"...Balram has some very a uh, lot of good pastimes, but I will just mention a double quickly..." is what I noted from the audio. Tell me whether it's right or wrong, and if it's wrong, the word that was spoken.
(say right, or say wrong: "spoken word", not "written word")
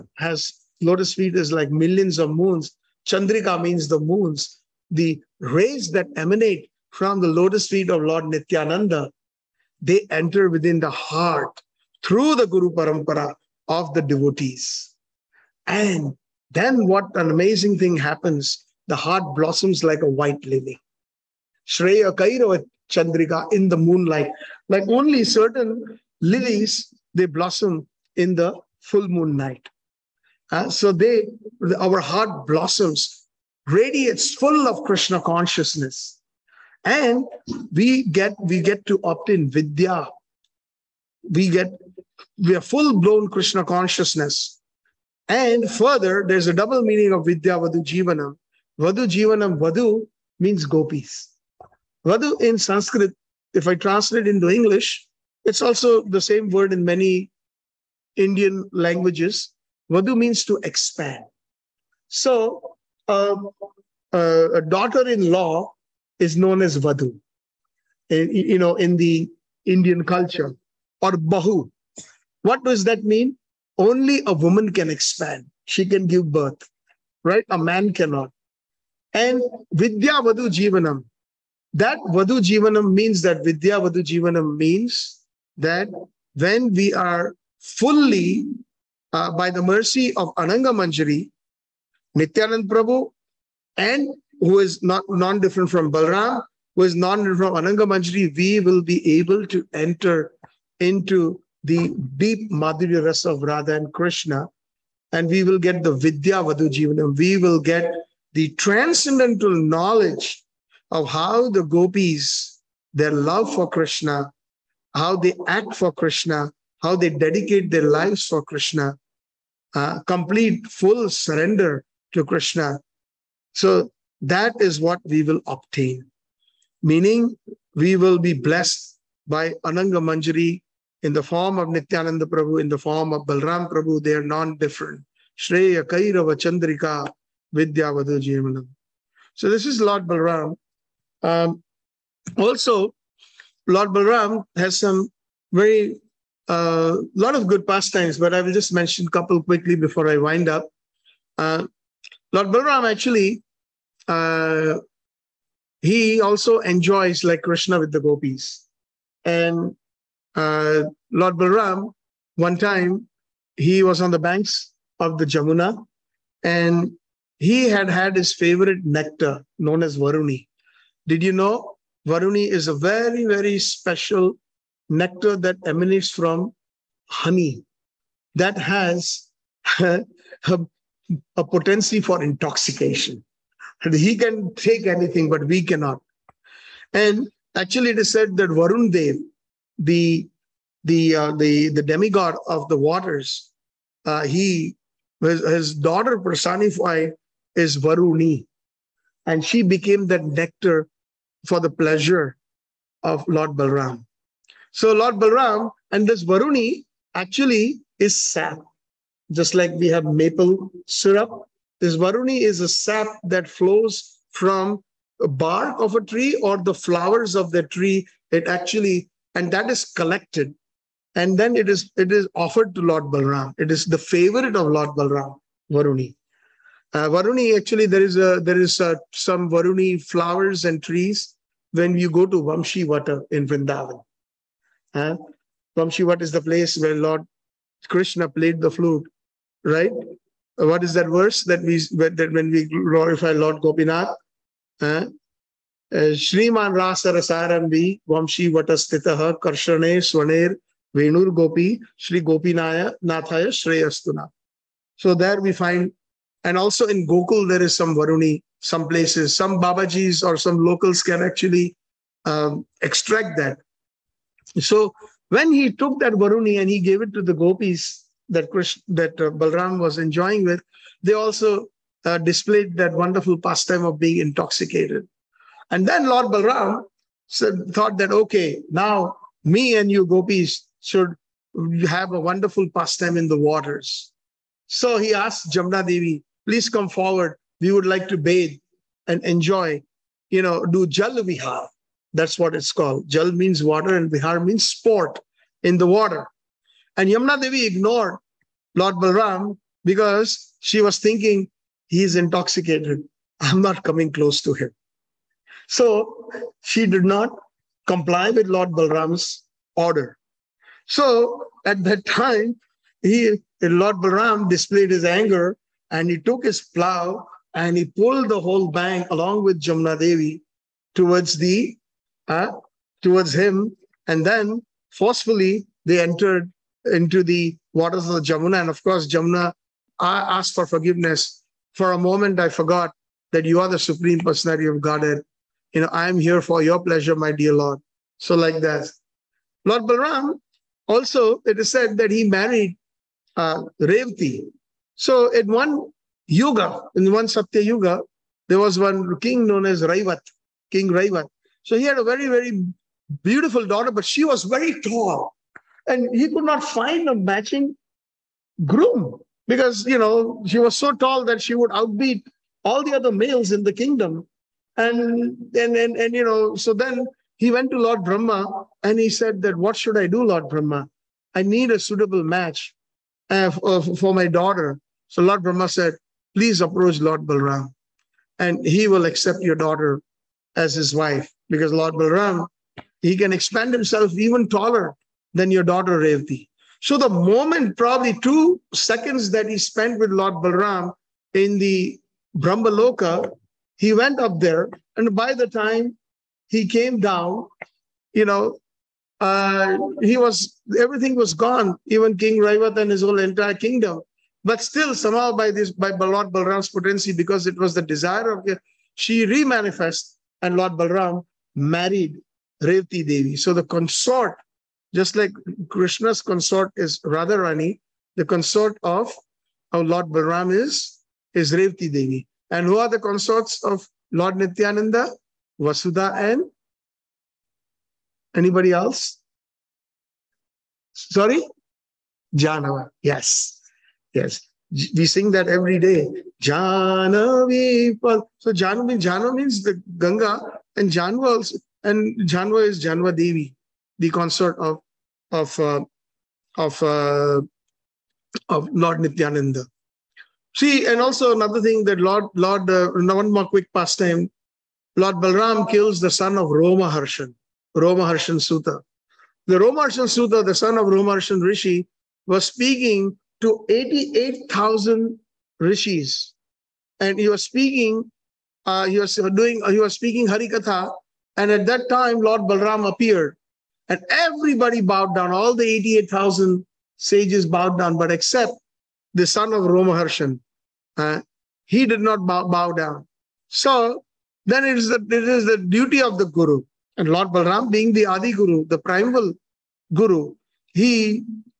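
wrong: "couple", not "double".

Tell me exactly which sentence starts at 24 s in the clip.
Like only certain lilies, they blossom in the full moon night.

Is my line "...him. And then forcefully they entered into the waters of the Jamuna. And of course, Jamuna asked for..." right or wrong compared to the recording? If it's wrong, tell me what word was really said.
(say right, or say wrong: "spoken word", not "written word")
right.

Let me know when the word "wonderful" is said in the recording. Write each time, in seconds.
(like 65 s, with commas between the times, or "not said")
272 s, 282 s.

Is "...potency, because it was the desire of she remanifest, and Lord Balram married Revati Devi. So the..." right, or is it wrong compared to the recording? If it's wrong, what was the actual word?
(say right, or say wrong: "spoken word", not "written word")
right.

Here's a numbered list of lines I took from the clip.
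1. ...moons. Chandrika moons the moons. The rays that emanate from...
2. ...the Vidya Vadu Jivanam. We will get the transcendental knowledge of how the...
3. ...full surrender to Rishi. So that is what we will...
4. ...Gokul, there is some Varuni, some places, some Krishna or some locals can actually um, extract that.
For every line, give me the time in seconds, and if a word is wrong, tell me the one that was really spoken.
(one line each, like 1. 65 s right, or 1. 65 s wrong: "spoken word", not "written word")
1. 2 s wrong: "means", not "moons"
2. 105 s right
3. 120 s wrong: "Krishna", not "Rishi"
4. 257 s wrong: "Babajis", not "Krishna".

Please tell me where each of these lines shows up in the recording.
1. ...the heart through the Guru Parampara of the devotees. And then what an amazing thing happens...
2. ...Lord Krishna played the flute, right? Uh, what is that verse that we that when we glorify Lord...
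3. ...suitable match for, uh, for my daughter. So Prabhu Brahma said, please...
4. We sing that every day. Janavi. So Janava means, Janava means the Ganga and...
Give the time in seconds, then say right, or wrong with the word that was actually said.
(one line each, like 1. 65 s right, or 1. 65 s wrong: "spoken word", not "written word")
1. 10 s right
2. 236 s right
3. 371 s wrong: "Lord", not "Prabhu"
4. 434 s right.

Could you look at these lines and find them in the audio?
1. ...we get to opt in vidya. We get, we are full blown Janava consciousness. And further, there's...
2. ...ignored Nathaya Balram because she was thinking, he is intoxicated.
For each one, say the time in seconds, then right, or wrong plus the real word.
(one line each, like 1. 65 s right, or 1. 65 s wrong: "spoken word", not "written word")
1. 38 s wrong: "Krishna", not "Janava"
2. 297 s wrong: "Lord", not "Nathaya".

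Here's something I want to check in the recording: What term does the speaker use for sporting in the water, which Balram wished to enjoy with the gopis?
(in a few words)
Jal Vihar.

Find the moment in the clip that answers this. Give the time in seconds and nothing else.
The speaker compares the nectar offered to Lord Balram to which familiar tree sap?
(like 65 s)
210 s.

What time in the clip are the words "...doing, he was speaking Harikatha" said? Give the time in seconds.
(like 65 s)
469 s.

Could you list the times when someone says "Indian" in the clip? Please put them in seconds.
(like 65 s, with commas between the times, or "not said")
58 s, 69 s.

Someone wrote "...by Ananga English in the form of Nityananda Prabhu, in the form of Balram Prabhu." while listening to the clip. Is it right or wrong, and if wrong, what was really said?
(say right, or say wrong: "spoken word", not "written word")
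wrong: "Manjari", not "English".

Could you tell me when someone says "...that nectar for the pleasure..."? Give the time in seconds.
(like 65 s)
200 s.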